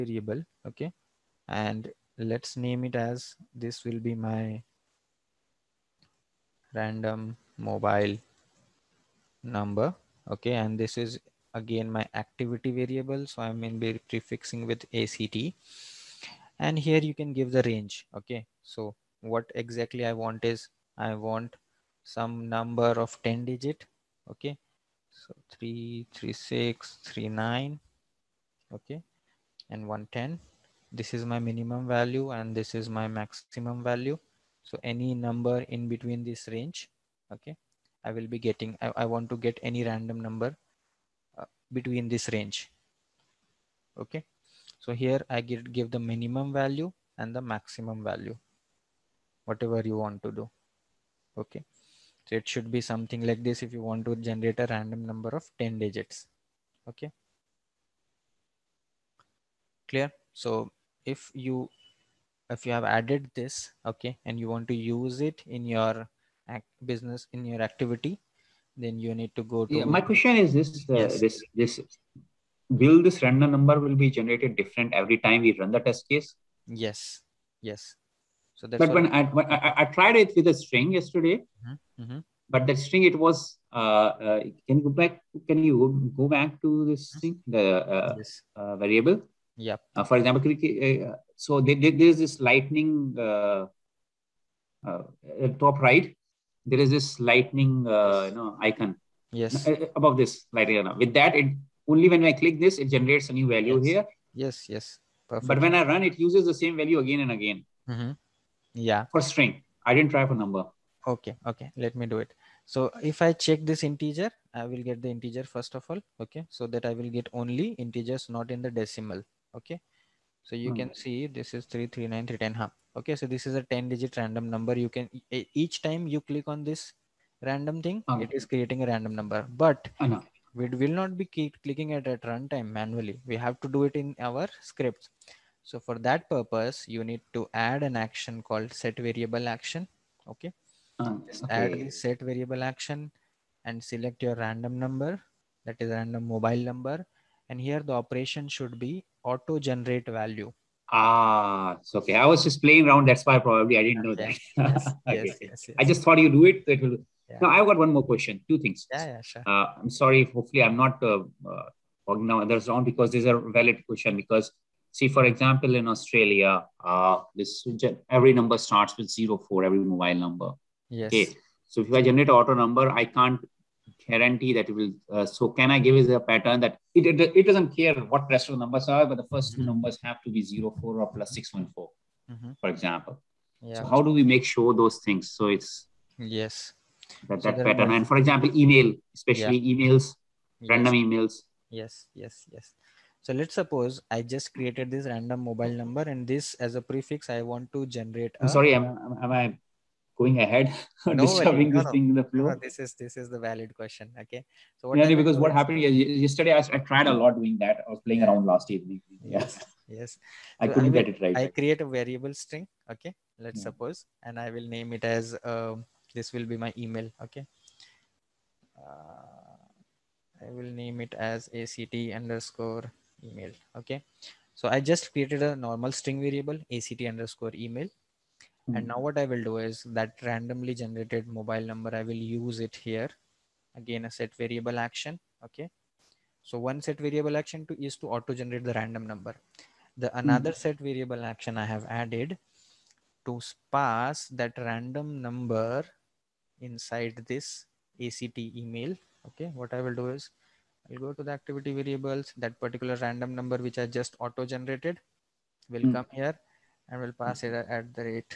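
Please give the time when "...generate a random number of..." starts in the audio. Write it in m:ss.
0:54.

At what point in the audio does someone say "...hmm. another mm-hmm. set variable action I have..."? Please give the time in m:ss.
4:00.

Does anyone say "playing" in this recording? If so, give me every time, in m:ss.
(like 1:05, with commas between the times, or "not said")
2:32, 3:28.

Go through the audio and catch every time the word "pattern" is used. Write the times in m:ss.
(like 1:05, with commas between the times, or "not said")
2:56, 3:07.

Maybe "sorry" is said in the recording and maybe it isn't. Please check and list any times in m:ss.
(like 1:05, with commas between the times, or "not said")
2:40, 3:18.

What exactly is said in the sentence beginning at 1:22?
but that string it was uh, uh, can you go back can you go back to this thing the uh, yes.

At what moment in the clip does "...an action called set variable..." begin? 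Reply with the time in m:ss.
2:17.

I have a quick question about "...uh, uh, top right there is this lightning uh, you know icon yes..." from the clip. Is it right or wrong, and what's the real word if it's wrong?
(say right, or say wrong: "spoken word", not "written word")
right.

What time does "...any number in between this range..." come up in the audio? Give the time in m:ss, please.
0:34.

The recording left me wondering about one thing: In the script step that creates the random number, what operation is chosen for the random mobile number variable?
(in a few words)
auto generate value.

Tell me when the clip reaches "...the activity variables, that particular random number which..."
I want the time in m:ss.
4:11.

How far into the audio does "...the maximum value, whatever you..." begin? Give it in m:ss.
0:47.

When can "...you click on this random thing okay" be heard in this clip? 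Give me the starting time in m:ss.
2:06.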